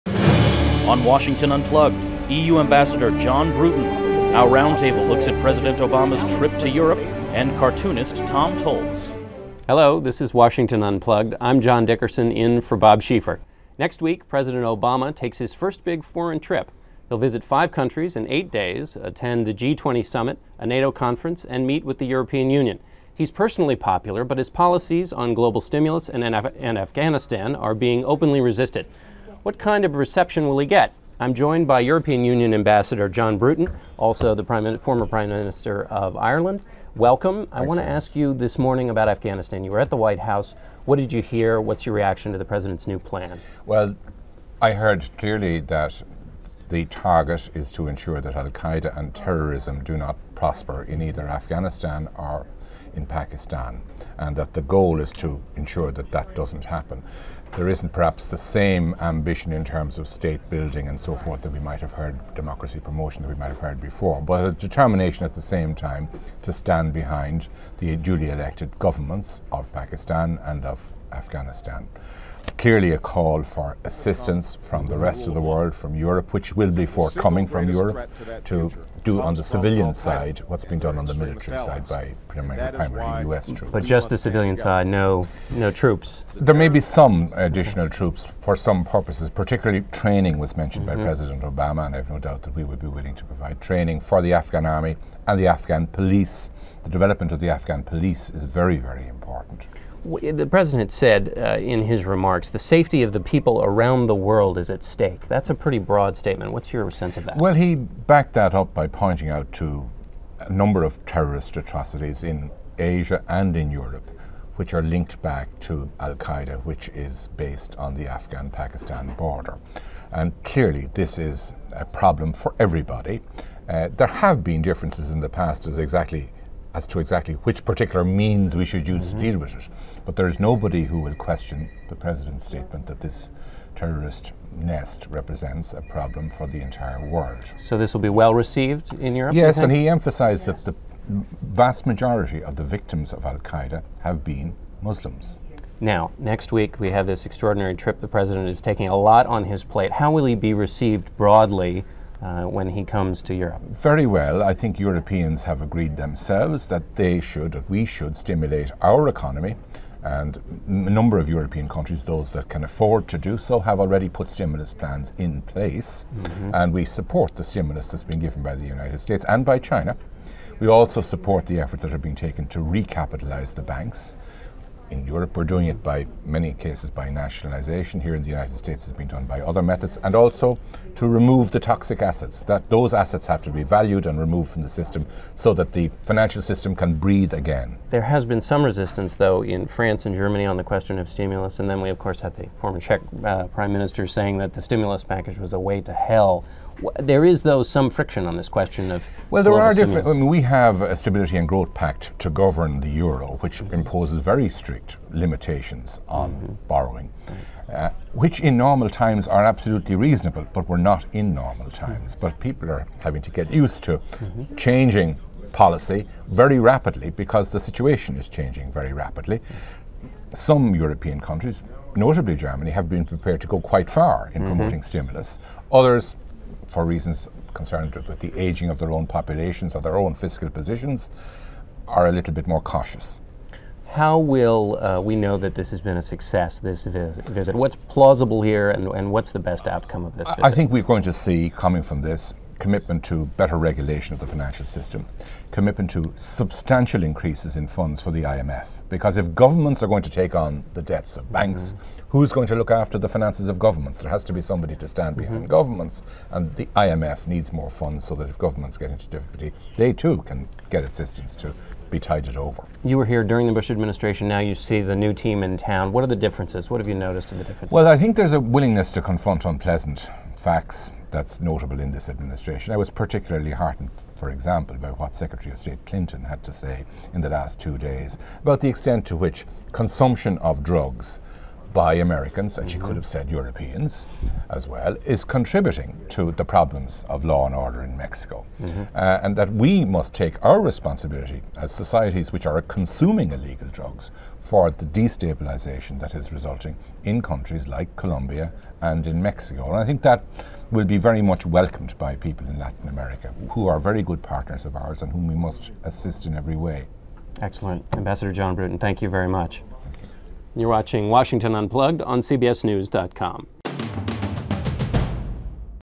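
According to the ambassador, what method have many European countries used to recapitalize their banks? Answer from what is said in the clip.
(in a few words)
nationalisation.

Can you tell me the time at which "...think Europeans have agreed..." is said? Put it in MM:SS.
02:34.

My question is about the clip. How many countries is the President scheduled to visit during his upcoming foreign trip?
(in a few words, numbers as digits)
5.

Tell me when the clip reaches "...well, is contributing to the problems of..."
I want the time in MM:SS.
04:44.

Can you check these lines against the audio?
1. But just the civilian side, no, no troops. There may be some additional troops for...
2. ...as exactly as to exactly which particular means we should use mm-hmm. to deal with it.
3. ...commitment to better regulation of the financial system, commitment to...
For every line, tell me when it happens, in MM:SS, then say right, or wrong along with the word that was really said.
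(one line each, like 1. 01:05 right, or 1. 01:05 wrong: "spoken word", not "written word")
1. 01:23 right
2. 02:05 right
3. 04:02 right.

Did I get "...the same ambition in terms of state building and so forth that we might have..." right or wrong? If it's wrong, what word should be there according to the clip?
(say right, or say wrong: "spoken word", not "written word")
right.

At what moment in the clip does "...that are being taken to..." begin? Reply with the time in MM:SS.
02:51.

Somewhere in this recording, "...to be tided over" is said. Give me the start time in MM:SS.
04:21.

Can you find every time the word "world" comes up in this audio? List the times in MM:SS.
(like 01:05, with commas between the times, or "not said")
01:15, 01:44, 02:17.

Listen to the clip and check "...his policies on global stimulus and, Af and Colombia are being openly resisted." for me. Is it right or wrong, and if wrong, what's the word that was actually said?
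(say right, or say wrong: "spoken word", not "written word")
wrong: "Afghanistan", not "Colombia".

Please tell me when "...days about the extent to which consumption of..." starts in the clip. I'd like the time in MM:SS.
04:37.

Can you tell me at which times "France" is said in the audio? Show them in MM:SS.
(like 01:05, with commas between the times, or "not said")
03:09.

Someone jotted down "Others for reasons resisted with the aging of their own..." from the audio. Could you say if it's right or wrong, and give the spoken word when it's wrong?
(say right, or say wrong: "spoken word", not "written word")
wrong: "concerned", not "resisted".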